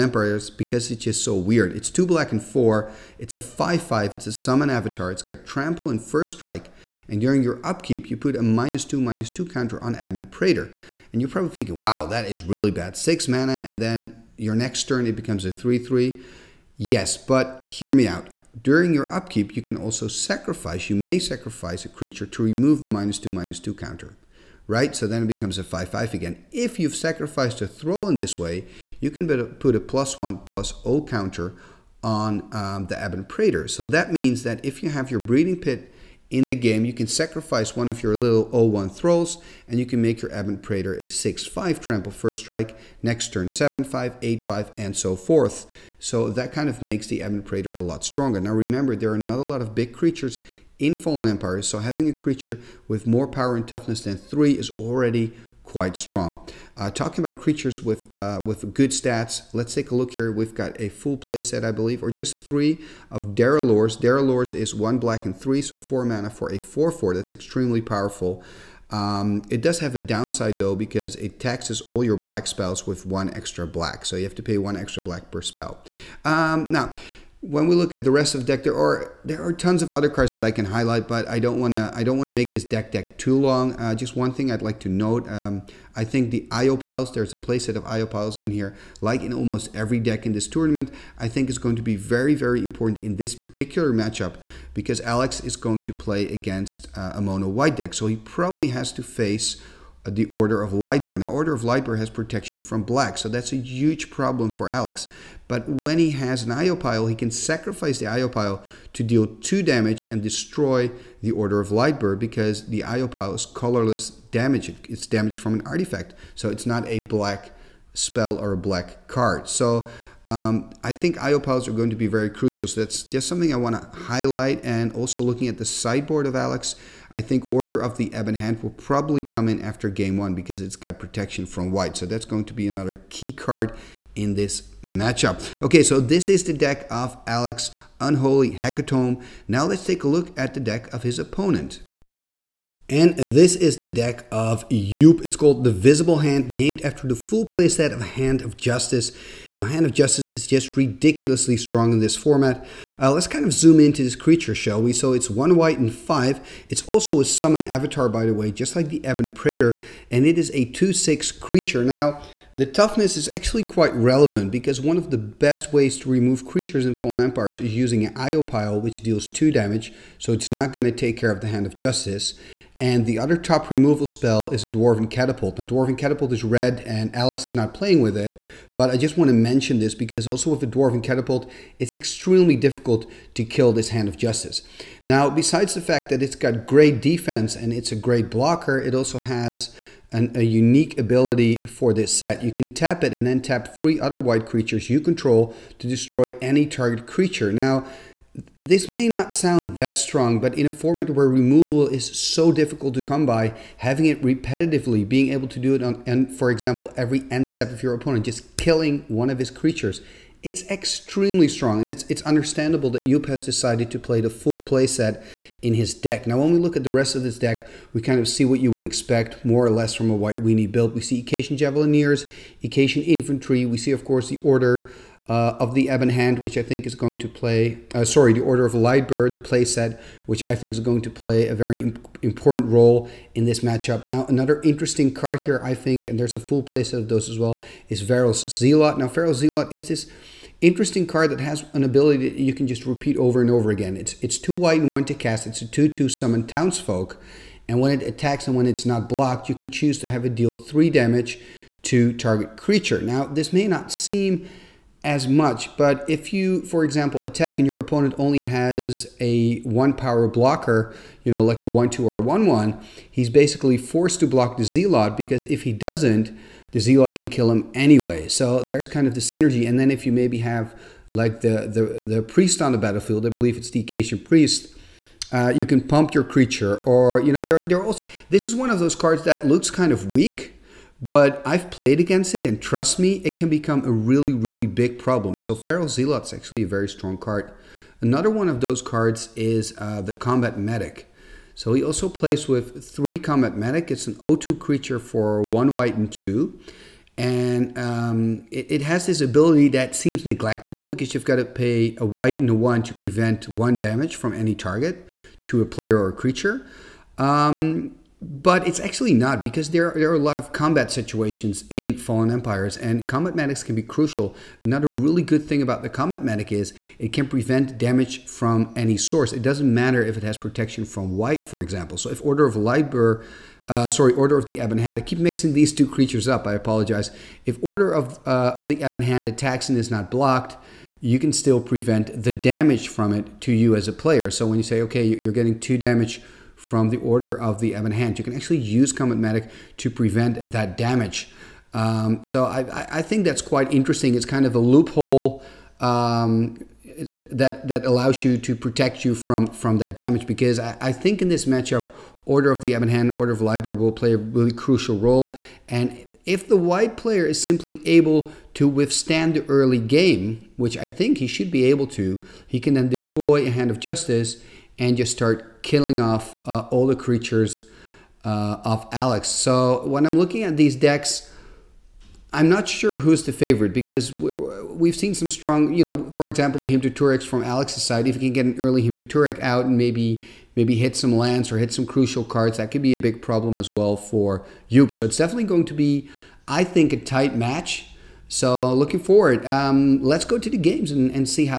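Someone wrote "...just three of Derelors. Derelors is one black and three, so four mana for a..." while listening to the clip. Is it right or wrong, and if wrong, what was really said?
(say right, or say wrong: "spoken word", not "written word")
right.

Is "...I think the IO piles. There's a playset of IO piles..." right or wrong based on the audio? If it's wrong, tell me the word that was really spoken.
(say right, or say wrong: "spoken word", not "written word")
right.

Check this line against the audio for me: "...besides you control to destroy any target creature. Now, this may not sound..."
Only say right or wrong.
wrong.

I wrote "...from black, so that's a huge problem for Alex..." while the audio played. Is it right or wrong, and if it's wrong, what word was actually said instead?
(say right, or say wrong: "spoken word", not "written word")
right.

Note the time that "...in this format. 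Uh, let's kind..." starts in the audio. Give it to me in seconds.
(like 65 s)
151 s.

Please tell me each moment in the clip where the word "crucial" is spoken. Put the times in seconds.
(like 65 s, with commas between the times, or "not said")
122 s, 313 s, 354 s, 381 s.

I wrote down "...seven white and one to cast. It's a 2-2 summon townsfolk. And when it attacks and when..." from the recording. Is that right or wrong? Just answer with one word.
wrong.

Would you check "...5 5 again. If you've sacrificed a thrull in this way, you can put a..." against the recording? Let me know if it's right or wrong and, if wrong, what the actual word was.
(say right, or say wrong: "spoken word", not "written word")
right.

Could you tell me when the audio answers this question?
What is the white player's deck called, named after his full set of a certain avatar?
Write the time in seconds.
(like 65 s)
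145 s.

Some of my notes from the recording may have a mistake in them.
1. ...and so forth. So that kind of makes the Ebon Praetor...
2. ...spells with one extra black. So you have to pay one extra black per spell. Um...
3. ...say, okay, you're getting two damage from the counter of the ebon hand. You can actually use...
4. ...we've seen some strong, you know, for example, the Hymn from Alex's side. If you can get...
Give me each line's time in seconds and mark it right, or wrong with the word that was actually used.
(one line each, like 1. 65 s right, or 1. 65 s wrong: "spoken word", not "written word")
1. 44 s right
2. 72 s right
3. 334 s wrong: "order", not "counter"
4. 374 s right.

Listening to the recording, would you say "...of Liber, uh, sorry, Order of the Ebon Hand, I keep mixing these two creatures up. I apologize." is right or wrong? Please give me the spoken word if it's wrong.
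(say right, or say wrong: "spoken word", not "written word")
right.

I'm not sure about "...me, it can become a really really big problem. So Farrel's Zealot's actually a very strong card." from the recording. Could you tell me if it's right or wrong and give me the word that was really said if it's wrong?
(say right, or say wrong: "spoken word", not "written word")
right.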